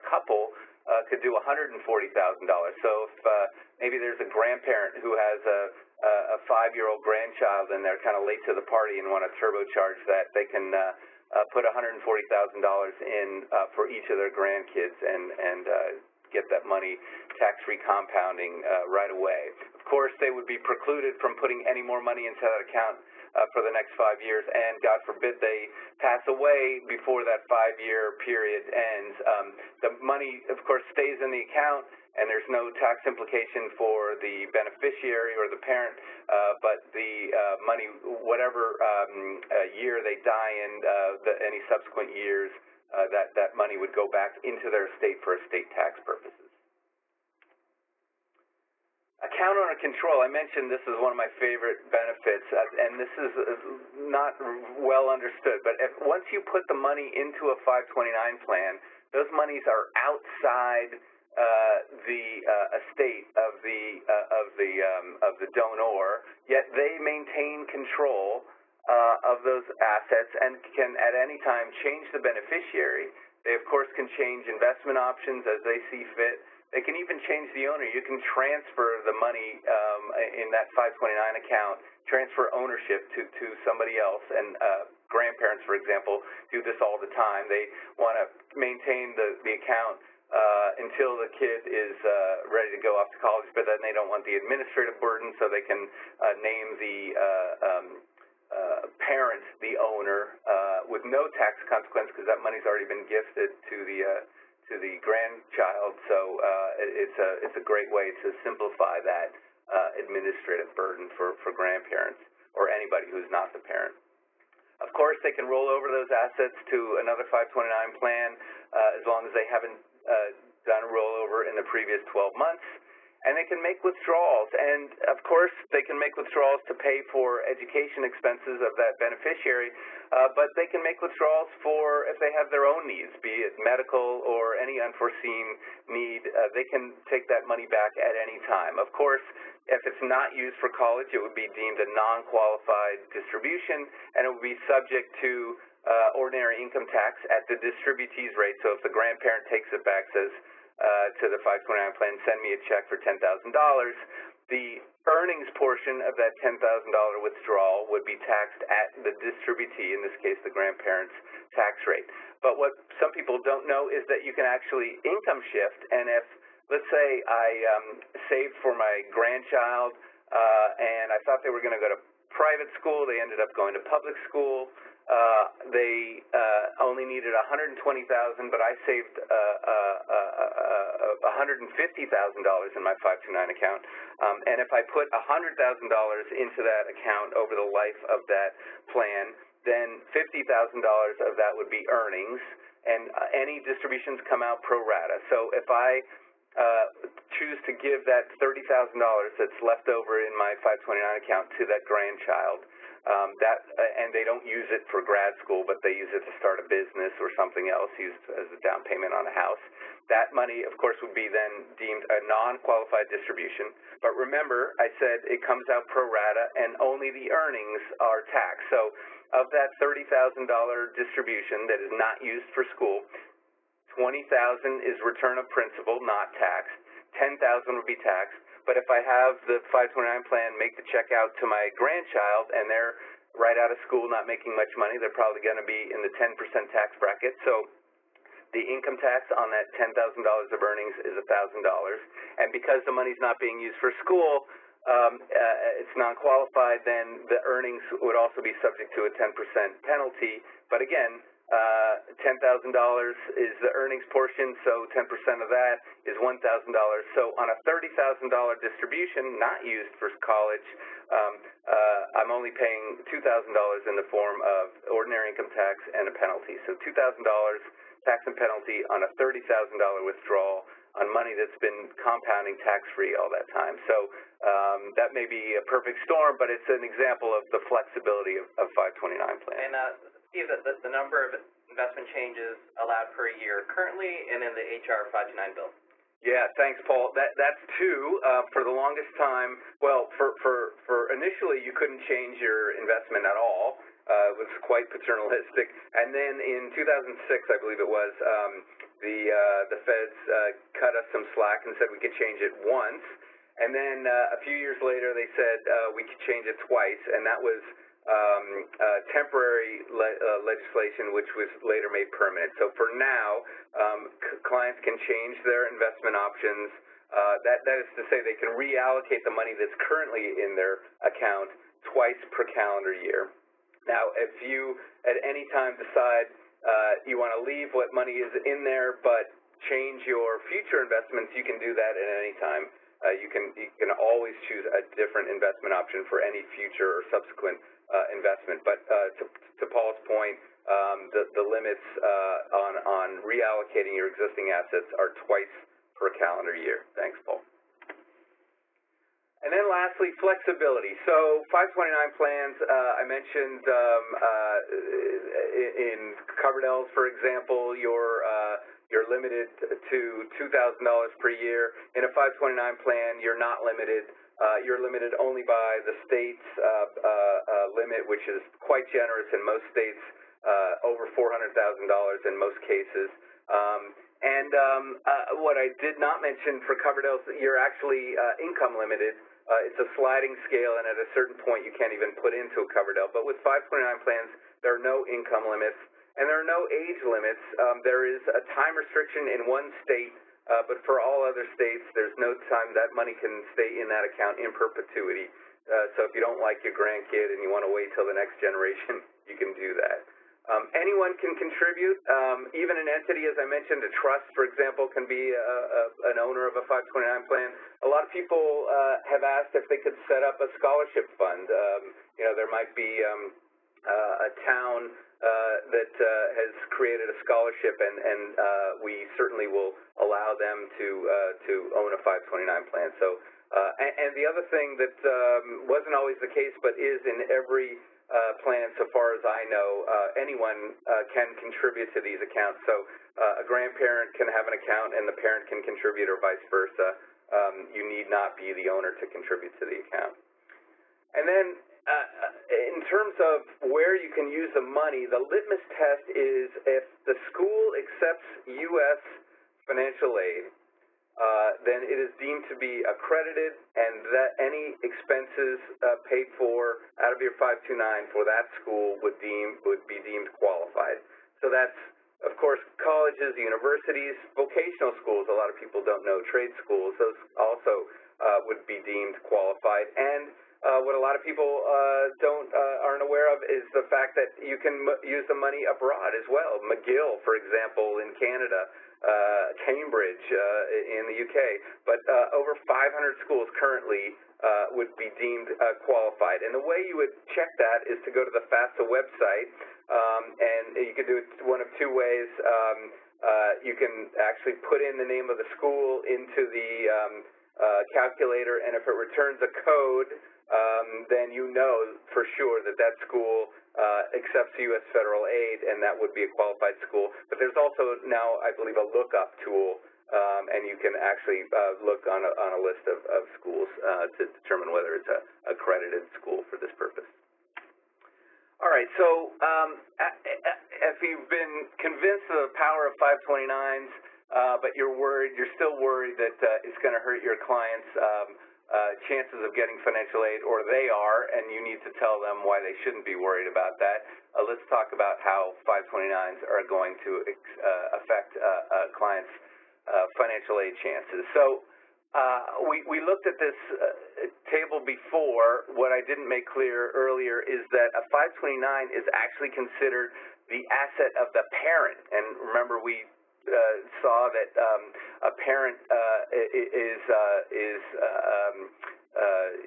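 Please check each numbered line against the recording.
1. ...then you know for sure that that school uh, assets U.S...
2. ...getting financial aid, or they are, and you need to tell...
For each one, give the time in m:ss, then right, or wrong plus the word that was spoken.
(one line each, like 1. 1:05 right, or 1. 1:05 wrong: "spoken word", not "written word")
1. 8:21 wrong: "accepts", not "assets"
2. 8:49 right.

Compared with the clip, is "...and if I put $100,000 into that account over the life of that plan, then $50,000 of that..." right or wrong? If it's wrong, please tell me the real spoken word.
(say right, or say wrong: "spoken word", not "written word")
right.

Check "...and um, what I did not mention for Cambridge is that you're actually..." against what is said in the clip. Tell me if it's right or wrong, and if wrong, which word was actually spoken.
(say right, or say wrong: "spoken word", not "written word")
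wrong: "Coverdell", not "Cambridge".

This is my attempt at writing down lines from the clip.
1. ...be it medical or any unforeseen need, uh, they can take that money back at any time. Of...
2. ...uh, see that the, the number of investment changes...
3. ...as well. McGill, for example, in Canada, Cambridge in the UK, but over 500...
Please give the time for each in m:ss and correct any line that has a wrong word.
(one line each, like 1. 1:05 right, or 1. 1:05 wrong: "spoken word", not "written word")
1. 2:13 right
2. 4:39 right
3. 7:56 right.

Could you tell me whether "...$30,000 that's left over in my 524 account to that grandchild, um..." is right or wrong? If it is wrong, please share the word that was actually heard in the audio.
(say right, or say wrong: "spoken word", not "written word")
wrong: "529", not "524".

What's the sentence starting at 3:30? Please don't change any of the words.
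That money, of course, would be then deemed a non-qualified distribution.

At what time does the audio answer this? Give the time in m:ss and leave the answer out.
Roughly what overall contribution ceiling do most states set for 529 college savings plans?
6:11.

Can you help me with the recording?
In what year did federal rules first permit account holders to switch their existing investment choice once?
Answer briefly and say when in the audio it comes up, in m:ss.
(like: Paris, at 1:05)
2006, at 4:56.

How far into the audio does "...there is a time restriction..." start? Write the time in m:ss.
6:27.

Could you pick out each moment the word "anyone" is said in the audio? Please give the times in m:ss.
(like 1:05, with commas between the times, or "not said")
6:40, 7:10.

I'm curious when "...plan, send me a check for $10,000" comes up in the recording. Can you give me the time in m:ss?
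2:31.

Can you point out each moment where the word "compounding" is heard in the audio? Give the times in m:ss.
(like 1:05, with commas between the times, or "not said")
0:17, 4:32.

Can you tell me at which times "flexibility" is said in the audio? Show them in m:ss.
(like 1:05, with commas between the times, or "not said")
4:37, 5:50.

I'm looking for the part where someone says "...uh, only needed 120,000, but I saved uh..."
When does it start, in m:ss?
2:56.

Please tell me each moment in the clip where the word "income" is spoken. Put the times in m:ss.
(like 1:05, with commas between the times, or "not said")
2:26, 2:45, 3:58, 4:25, 6:18, 6:25.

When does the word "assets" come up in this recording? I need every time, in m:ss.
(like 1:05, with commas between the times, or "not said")
1:09, 1:56, 5:44, 9:10.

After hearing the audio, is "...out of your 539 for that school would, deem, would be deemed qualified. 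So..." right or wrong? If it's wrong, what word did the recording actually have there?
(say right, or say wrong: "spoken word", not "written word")
wrong: "529", not "539".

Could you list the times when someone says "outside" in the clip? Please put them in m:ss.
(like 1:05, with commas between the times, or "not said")
0:59.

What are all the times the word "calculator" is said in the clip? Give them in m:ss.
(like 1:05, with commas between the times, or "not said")
8:17.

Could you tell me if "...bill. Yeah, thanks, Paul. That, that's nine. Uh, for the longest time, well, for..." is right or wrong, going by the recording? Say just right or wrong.
wrong.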